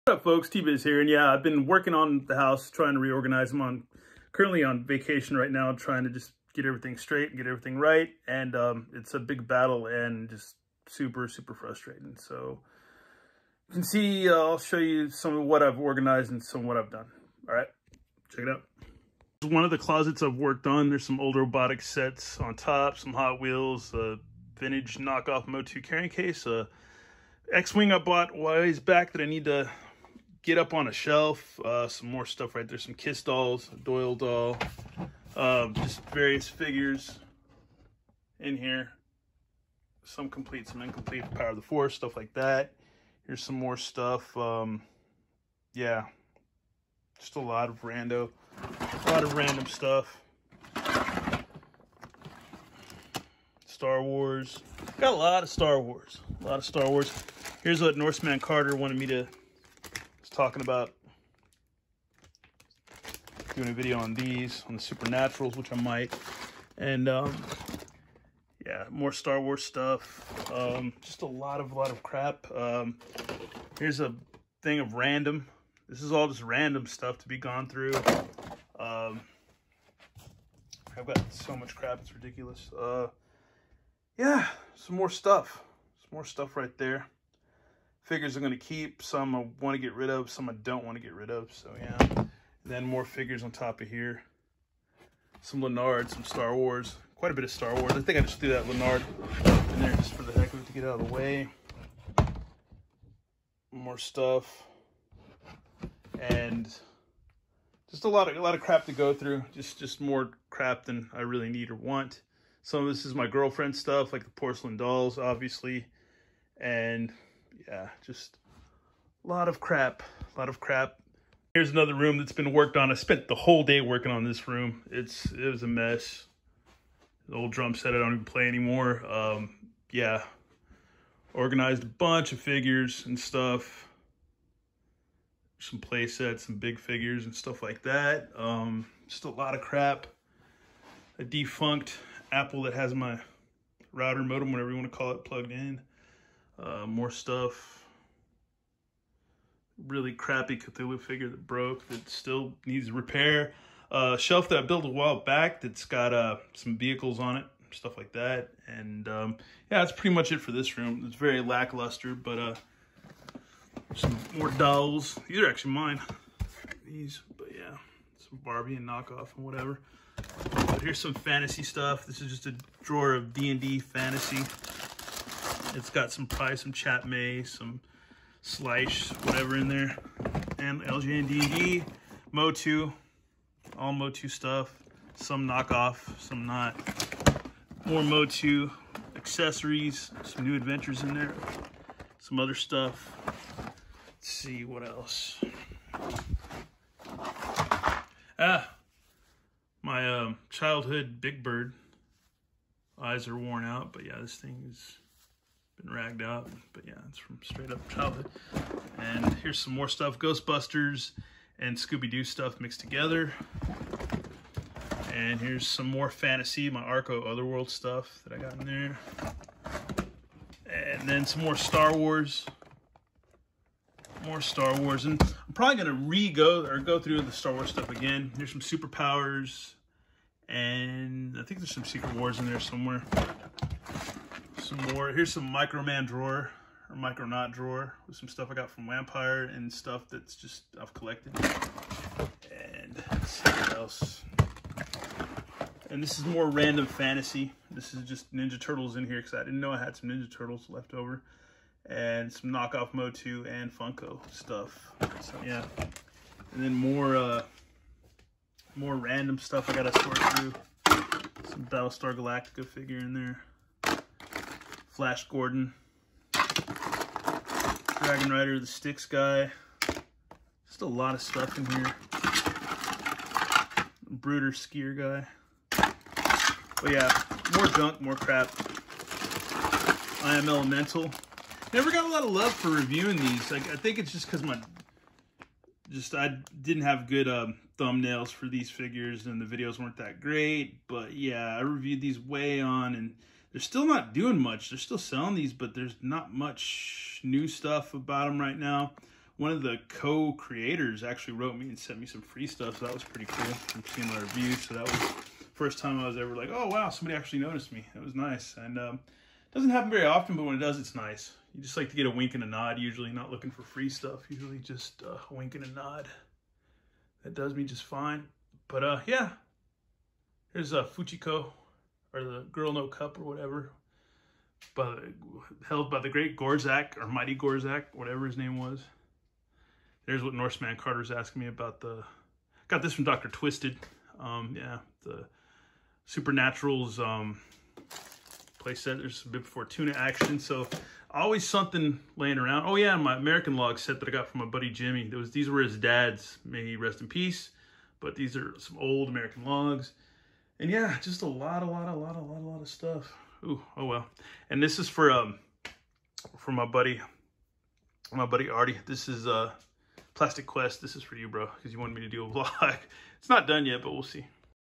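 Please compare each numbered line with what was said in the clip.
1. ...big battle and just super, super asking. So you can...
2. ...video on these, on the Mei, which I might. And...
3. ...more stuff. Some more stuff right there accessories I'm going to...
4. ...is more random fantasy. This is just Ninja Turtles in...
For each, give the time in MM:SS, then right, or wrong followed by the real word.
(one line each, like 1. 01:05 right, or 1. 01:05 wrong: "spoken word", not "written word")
1. 00:09 wrong: "frustrating", not "asking"
2. 01:03 wrong: "Supernaturals", not "Mei"
3. 01:24 wrong: "figures", not "accessories"
4. 04:06 right.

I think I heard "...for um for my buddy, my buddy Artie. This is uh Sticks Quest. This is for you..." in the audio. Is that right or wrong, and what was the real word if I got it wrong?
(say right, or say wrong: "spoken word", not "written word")
wrong: "Plastic", not "Sticks".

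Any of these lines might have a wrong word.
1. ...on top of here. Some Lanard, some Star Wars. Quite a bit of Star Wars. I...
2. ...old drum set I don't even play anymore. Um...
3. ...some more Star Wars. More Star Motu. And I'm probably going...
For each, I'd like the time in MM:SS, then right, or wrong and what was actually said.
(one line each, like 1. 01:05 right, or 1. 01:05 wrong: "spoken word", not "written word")
1. 01:33 right
2. 02:07 right
3. 03:41 wrong: "Wars", not "Motu".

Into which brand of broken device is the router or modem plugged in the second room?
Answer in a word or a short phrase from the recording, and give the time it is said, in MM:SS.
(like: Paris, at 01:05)
Apple, at 02:22.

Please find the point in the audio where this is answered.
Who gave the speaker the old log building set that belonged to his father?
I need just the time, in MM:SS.
05:44.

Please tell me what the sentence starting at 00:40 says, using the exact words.
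Some complete, some incomplete, Power of the Force, stuff like that.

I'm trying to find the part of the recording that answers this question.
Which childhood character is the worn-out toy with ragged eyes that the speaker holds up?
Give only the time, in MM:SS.
03:21.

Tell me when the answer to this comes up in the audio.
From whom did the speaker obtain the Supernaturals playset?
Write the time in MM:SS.
05:33.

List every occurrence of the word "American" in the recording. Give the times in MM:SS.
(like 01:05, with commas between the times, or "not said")
05:43, 05:49.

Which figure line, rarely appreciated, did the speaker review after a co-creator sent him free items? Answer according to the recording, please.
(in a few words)
I am Elemental.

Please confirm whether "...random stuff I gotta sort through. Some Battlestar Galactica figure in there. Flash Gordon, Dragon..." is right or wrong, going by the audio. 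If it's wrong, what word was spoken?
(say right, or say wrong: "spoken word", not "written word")
right.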